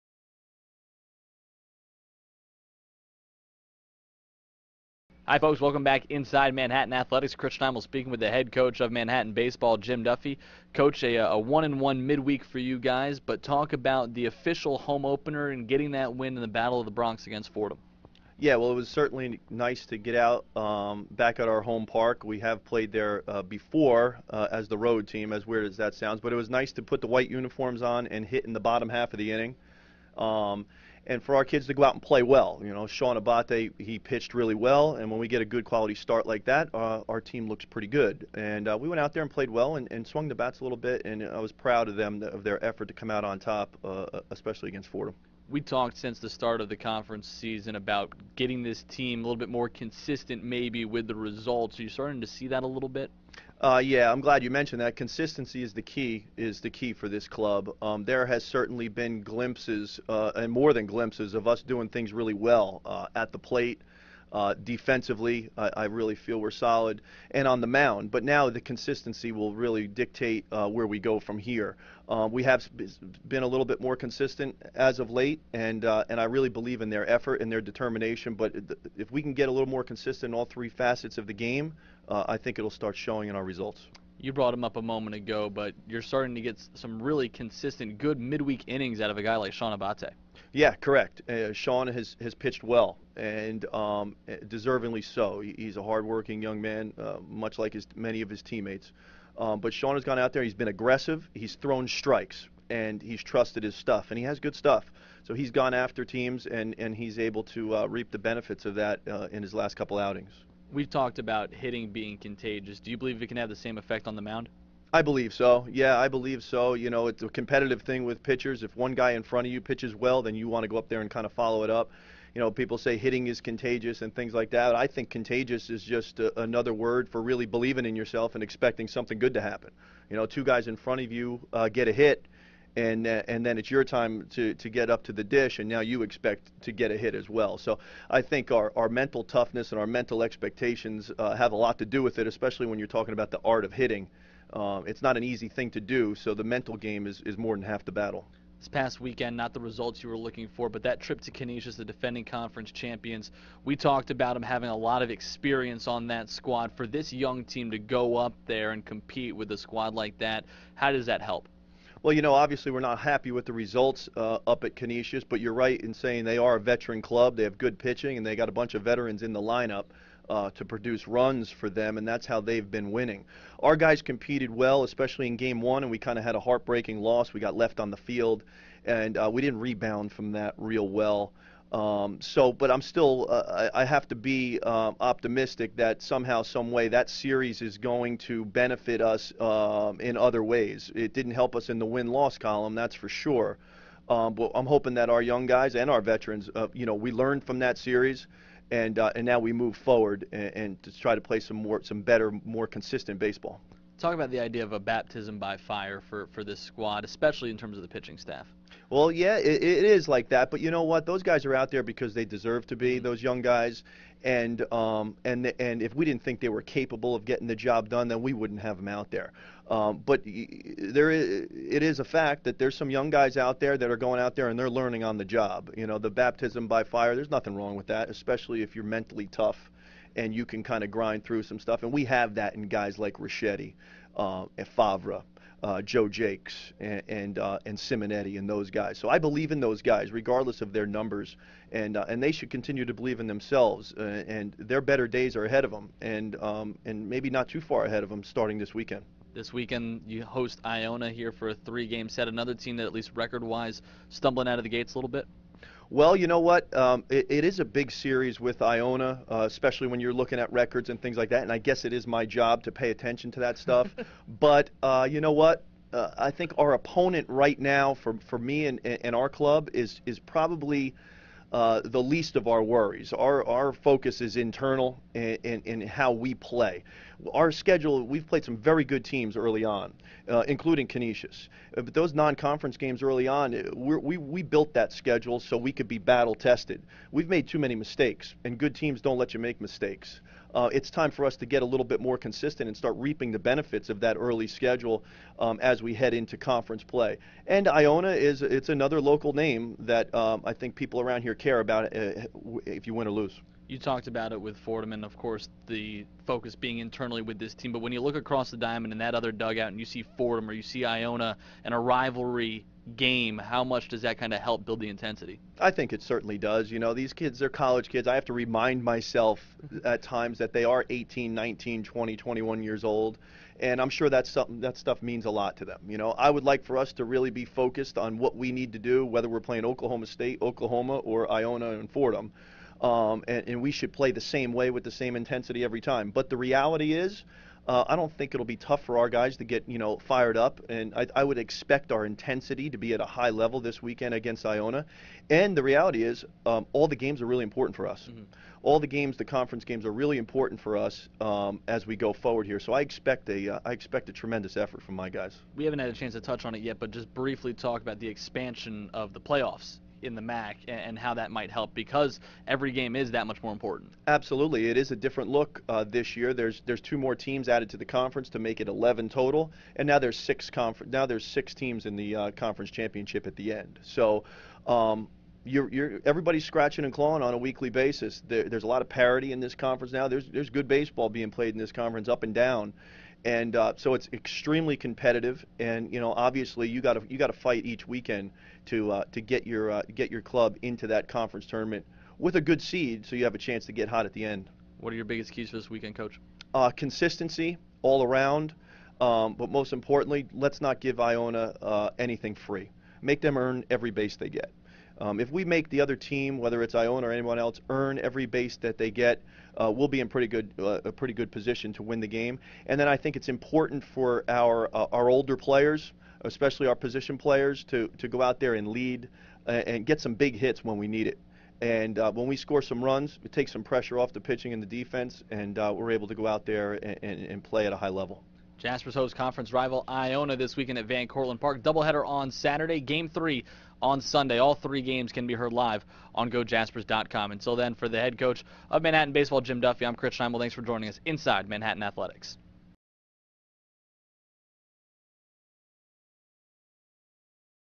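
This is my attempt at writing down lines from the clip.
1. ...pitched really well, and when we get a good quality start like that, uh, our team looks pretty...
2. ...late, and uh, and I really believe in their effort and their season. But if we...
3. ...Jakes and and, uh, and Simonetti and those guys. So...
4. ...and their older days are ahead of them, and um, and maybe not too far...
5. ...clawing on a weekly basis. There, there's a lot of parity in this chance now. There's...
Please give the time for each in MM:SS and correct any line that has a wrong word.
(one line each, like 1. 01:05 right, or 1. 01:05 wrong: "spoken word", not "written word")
1. 00:33 right
2. 01:15 wrong: "determination", not "season"
3. 03:56 right
4. 04:04 wrong: "better", not "older"
5. 06:16 wrong: "conference", not "chance".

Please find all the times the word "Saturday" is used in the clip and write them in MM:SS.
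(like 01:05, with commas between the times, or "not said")
07:12.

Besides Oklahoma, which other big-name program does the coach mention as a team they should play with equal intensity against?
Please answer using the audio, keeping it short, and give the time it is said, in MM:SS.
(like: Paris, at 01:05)
Oklahoma State, at 05:29.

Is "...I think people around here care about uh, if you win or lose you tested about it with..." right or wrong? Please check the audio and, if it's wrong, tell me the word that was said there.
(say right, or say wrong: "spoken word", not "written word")
wrong: "talked", not "tested".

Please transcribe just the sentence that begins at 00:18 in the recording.
Yeah, well, it was certainly nice to get out um, back at our home park.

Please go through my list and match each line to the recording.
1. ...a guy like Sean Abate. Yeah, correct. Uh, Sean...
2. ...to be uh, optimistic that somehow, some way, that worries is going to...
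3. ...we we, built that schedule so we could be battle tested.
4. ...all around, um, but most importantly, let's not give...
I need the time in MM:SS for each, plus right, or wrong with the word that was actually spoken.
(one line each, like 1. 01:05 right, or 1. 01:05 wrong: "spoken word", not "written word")
1. 01:29 right
2. 03:04 wrong: "series", not "worries"
3. 04:43 right
4. 06:37 right.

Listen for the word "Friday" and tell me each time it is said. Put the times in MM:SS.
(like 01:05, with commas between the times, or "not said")
not said.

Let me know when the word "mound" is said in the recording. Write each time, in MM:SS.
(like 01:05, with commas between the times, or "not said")
01:07, 01:54.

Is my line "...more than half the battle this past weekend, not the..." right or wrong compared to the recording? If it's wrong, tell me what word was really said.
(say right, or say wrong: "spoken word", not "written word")
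right.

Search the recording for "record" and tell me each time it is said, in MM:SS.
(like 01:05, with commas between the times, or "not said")
04:13, 04:20.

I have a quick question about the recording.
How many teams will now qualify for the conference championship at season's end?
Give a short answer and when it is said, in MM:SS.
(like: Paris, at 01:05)
6, at 06:11.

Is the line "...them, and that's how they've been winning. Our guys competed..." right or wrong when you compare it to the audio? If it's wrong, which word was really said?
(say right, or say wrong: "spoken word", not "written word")
right.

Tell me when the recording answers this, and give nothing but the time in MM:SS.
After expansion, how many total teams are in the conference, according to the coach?
06:08.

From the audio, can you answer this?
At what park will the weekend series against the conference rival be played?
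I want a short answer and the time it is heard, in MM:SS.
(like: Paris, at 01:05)
Van Cortlandt Park, at 07:10.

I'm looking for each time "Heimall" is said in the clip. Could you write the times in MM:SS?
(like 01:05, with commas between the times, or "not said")
00:07, 07:20.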